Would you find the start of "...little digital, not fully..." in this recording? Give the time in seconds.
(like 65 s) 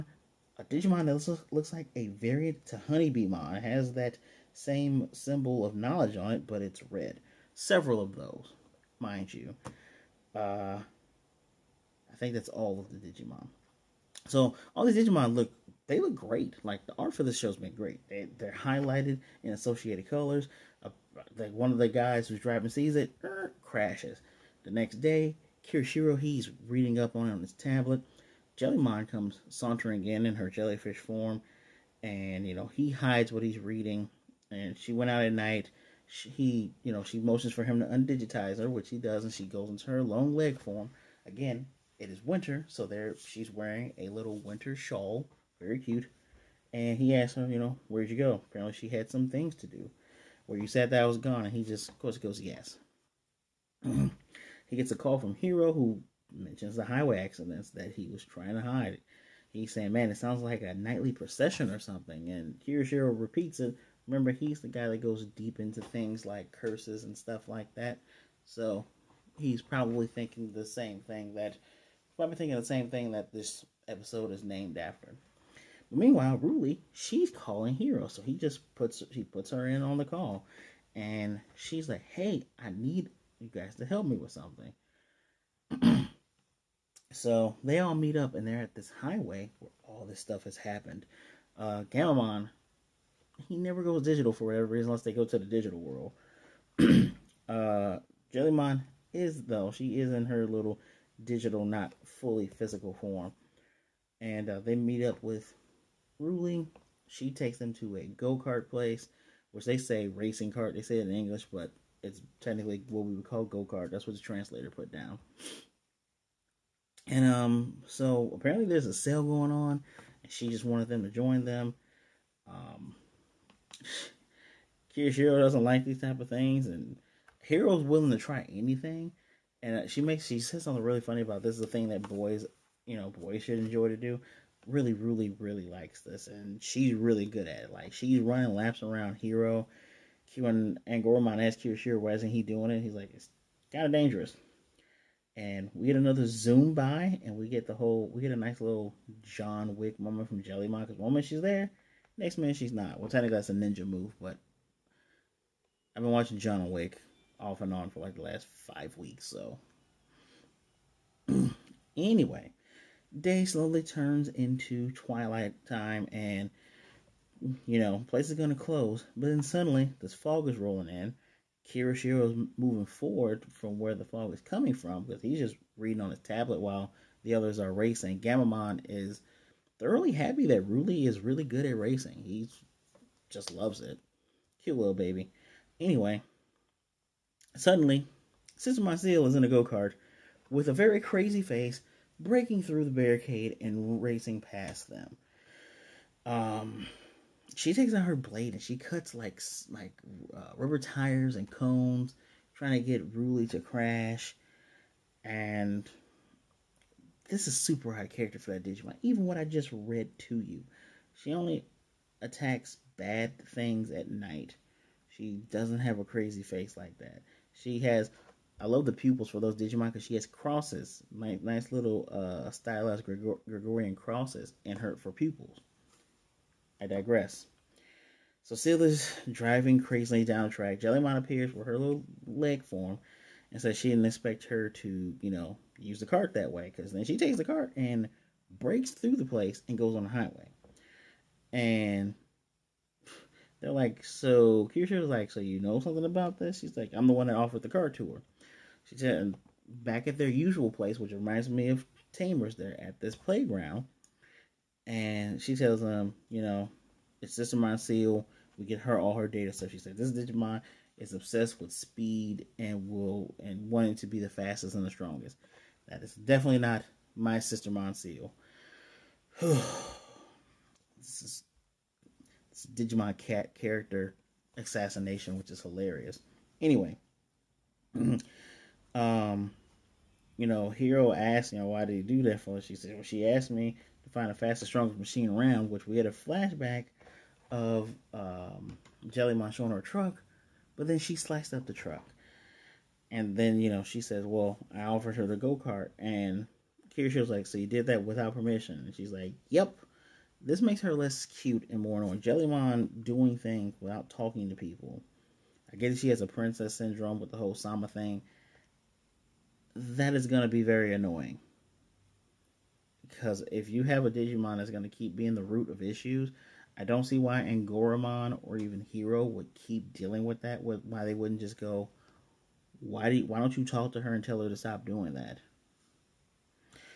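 100 s.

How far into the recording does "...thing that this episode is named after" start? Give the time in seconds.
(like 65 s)
72 s.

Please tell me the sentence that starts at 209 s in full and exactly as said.
Even what I just read to you, she only attacks bad things at night.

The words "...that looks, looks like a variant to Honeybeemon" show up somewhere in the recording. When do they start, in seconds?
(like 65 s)
1 s.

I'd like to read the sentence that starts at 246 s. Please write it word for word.
She's like, I'm the one that offered the cart to her.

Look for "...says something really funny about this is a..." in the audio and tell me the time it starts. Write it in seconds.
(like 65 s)
130 s.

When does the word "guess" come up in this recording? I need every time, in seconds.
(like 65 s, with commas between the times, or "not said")
305 s.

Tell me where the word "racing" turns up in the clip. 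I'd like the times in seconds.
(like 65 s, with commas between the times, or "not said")
110 s, 177 s, 181 s, 194 s.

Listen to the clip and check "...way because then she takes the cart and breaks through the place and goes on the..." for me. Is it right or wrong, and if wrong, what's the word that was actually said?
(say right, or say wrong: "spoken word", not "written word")
right.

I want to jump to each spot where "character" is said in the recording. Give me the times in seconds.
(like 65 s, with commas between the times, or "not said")
208 s, 273 s.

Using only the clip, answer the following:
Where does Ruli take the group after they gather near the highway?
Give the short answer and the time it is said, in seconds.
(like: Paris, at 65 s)
A go kart place, at 108 s.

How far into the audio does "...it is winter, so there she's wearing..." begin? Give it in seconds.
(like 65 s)
41 s.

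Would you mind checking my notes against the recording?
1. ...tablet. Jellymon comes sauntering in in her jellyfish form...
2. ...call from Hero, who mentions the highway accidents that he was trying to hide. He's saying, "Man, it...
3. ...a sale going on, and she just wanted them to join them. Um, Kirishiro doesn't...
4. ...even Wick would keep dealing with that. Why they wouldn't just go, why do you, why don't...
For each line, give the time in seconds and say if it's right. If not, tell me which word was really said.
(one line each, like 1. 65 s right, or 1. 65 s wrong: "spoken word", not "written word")
1. 27 s right
2. 54 s right
3. 118 s right
4. 318 s wrong: "Hero", not "Wick".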